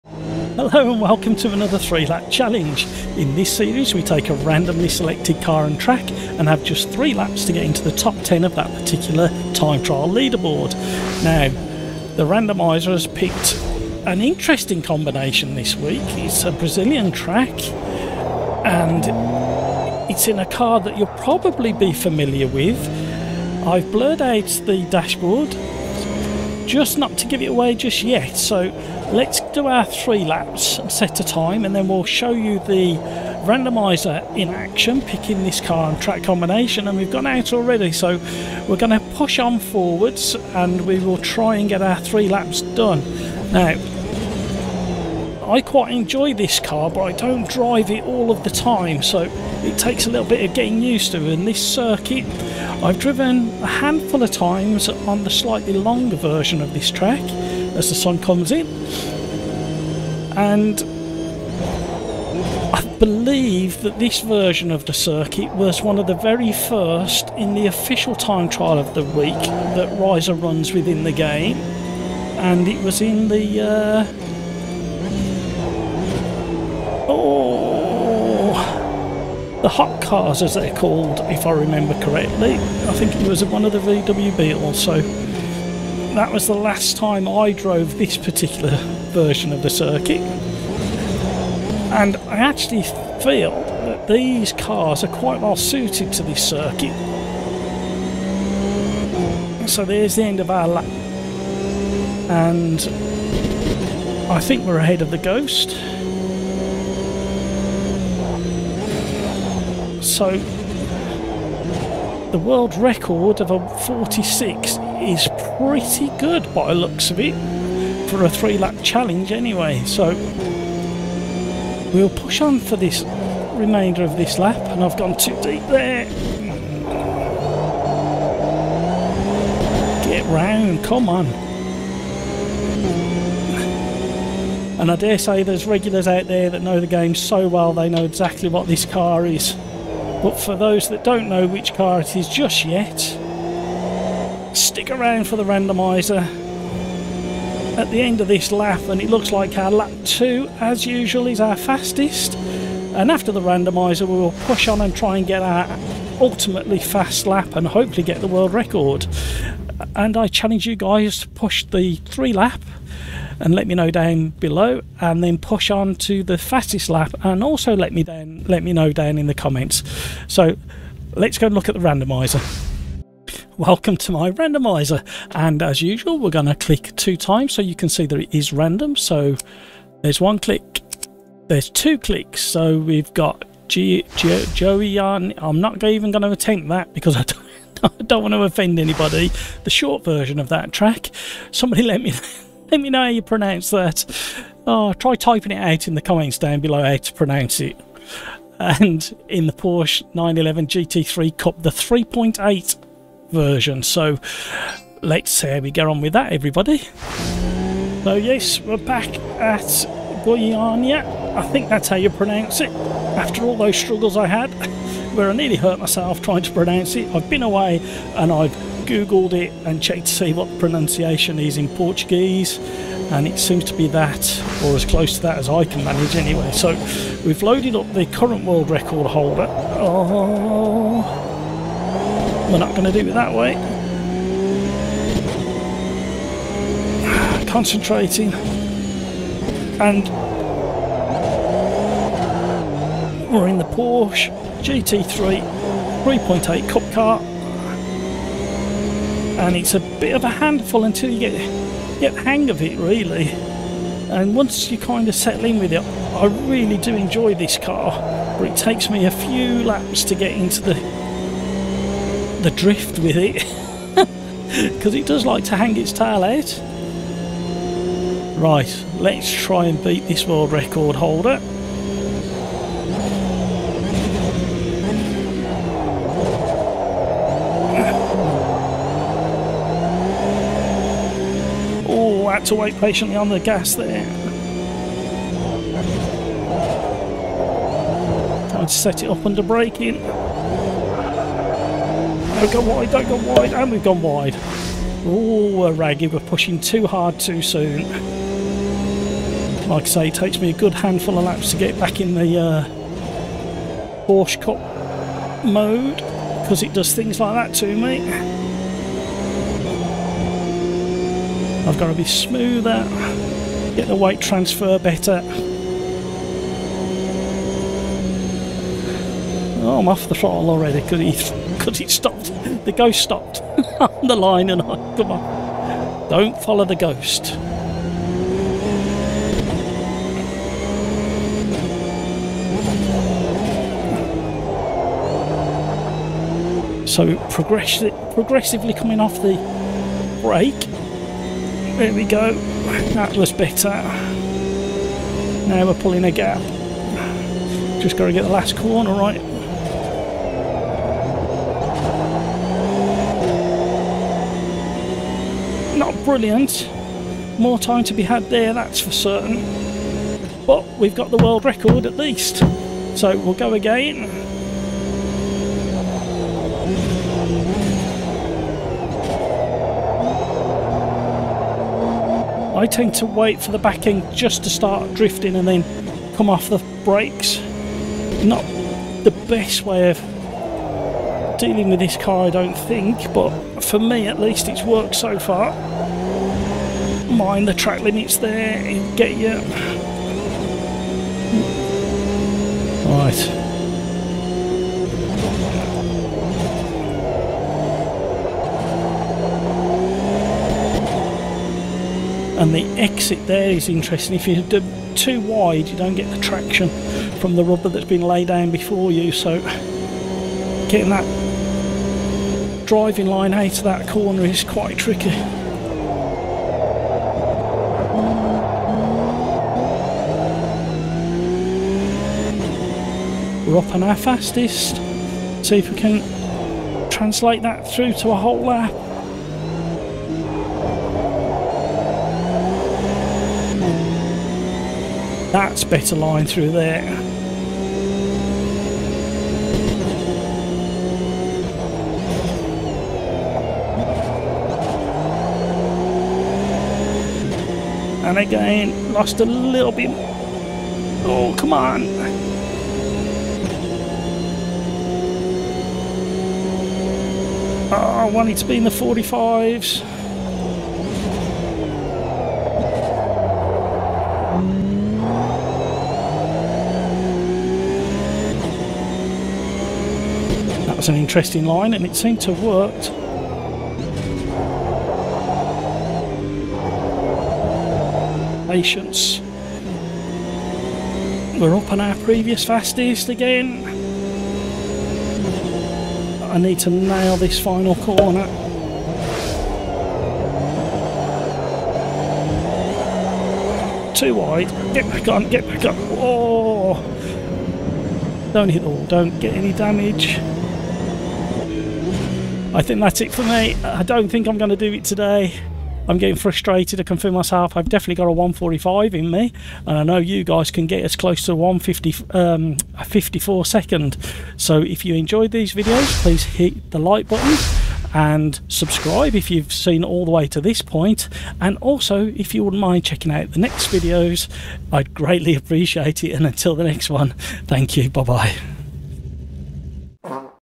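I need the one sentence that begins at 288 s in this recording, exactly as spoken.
Time to set it up under braking.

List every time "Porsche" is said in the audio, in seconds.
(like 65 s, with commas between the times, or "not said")
199 s, 243 s, 304 s.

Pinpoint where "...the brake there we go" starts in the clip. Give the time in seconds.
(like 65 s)
339 s.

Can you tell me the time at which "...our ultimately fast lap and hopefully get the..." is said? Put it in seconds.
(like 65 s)
155 s.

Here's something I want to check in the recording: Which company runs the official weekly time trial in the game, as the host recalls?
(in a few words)
Reiza.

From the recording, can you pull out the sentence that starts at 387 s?
Mind the track limits there, get you.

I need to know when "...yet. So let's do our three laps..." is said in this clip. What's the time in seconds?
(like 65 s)
28 s.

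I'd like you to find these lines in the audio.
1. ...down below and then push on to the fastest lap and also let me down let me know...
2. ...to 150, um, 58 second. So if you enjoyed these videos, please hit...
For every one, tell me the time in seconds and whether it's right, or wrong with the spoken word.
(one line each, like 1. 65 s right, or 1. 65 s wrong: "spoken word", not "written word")
1. 163 s right
2. 511 s wrong: "54", not "58".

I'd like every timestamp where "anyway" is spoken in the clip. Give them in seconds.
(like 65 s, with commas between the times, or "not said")
119 s, 226 s.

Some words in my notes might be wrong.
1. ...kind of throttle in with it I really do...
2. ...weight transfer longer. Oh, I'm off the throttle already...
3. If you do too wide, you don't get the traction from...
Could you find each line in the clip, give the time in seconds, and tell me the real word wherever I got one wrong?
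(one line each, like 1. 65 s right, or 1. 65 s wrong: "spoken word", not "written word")
1. 254 s wrong: "settle", not "throttle"
2. 313 s wrong: "better", not "longer"
3. 404 s right.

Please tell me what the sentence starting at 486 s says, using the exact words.
I need to nail this final corner.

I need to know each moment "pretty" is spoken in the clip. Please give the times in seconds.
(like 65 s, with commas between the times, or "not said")
115 s.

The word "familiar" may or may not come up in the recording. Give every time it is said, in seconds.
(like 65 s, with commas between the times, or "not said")
21 s.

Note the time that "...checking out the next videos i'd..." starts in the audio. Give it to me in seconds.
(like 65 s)
522 s.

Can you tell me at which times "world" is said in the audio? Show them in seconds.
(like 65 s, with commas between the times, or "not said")
112 s, 158 s, 228 s, 270 s, 361 s.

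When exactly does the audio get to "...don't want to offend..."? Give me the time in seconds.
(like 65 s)
188 s.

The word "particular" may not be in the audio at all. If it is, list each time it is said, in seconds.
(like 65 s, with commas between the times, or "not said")
8 s, 88 s.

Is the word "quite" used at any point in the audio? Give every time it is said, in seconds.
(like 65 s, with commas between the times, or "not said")
45 s, 95 s, 414 s.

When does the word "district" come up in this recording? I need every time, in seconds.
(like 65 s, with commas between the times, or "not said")
not said.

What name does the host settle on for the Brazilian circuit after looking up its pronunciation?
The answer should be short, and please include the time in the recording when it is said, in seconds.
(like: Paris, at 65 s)
Goiania, at 210 s.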